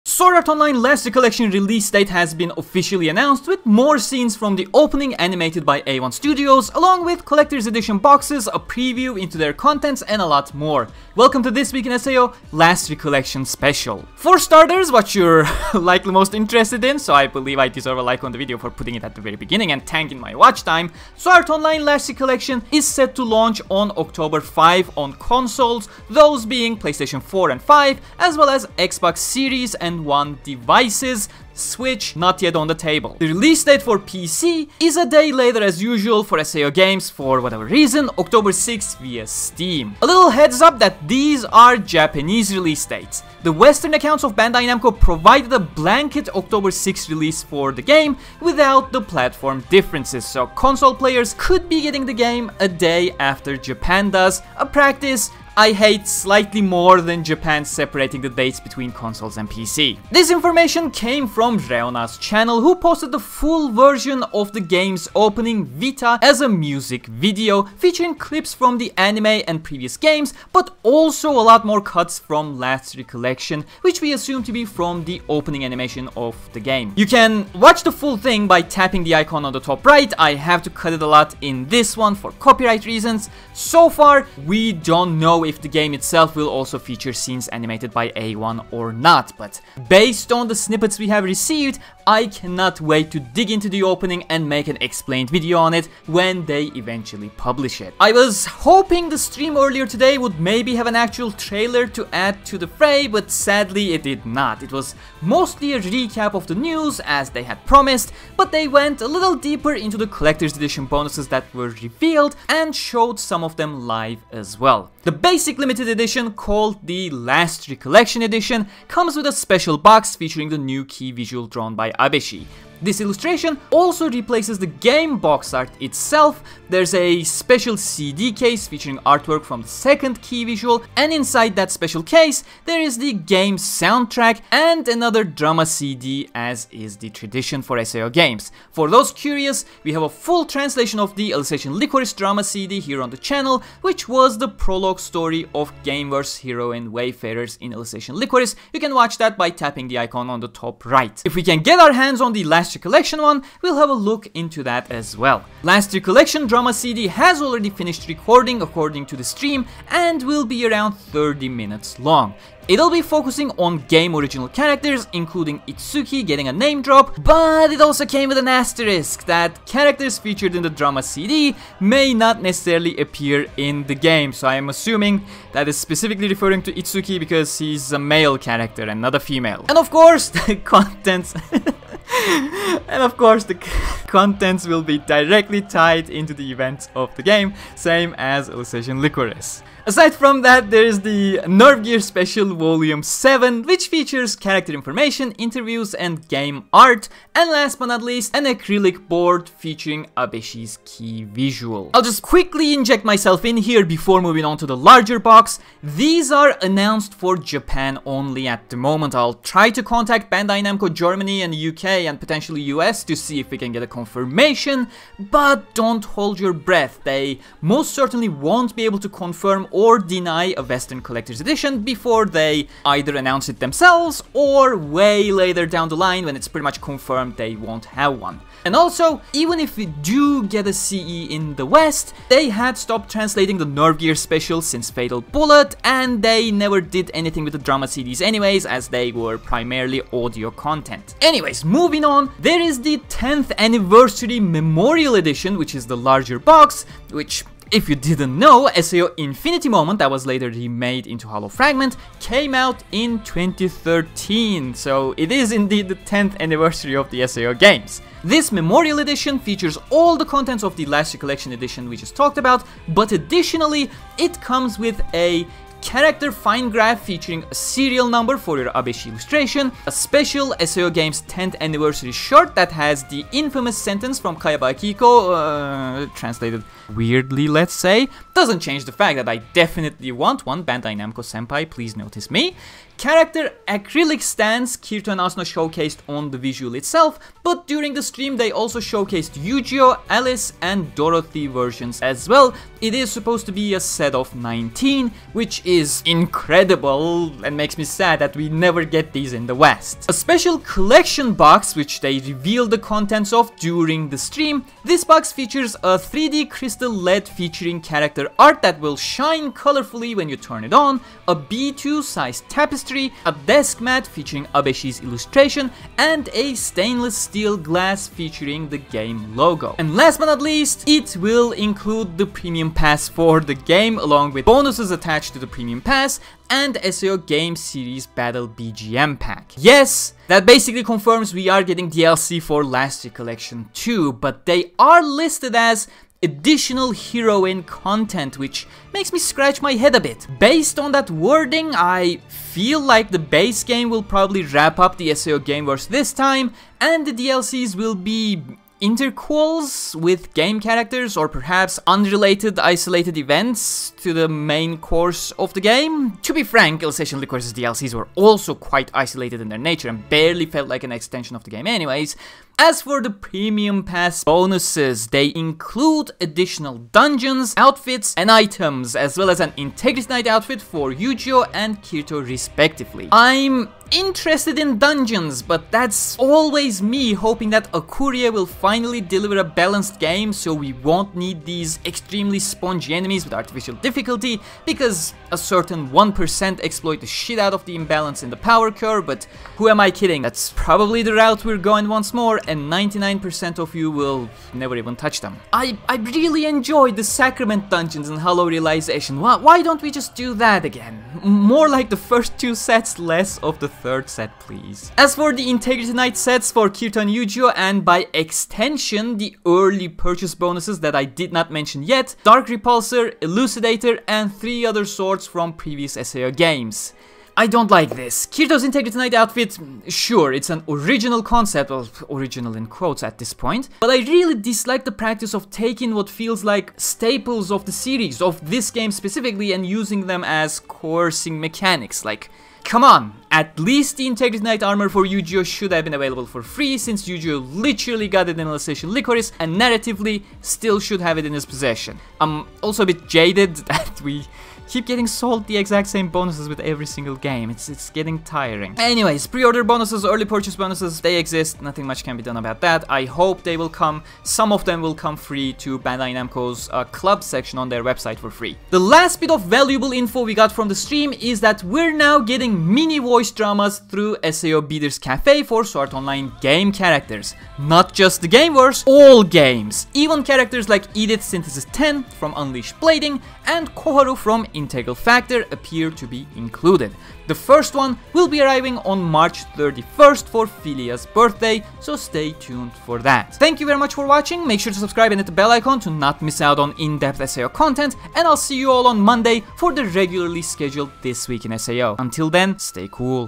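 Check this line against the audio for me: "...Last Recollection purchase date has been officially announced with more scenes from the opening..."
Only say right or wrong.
wrong.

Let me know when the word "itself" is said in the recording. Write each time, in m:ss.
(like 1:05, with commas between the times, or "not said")
1:25, 2:05, 4:46.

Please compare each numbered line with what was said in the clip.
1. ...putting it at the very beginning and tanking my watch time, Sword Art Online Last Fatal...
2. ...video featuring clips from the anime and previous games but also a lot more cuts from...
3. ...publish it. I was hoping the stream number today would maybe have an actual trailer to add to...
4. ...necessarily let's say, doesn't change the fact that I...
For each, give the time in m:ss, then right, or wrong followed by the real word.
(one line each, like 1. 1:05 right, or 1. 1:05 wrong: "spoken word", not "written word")
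1. 0:18 wrong: "Recollection", not "Fatal"
2. 1:07 right
3. 1:37 wrong: "earlier", not "number"
4. 4:36 wrong: "weirdly", not "necessarily".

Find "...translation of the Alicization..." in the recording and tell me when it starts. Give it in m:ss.
2:20.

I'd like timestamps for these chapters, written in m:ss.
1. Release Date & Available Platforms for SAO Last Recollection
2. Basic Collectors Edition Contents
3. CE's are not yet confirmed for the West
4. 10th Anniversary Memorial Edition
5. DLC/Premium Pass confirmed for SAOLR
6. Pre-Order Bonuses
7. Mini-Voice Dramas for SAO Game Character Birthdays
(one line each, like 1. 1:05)
1. 0:14
2. 1:48
3. 3:22
4. 4:01
5. 5:20
6. 6:45
7. 7:38.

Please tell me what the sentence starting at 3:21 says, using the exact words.
I'll just quickly inject myself in here before moving on to the larger box.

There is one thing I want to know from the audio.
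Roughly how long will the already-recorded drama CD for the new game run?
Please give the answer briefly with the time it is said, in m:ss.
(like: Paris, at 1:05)
30 minutes, at 2:40.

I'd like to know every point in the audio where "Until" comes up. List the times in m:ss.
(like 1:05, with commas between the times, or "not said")
8:11.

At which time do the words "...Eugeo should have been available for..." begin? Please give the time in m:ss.
7:15.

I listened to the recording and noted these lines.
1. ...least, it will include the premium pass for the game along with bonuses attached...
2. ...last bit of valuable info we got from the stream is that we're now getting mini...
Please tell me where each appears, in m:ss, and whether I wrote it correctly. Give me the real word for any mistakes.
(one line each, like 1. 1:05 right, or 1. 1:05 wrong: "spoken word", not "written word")
1. 5:20 right
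2. 7:38 right.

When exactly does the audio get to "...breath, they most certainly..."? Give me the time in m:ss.
3:36.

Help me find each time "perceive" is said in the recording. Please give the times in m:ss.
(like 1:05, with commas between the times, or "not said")
not said.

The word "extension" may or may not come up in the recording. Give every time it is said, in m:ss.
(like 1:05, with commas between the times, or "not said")
6:00, 6:48.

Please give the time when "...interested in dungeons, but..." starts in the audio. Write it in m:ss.
6:13.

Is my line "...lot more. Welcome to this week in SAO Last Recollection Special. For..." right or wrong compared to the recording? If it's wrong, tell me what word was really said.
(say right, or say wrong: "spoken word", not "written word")
right.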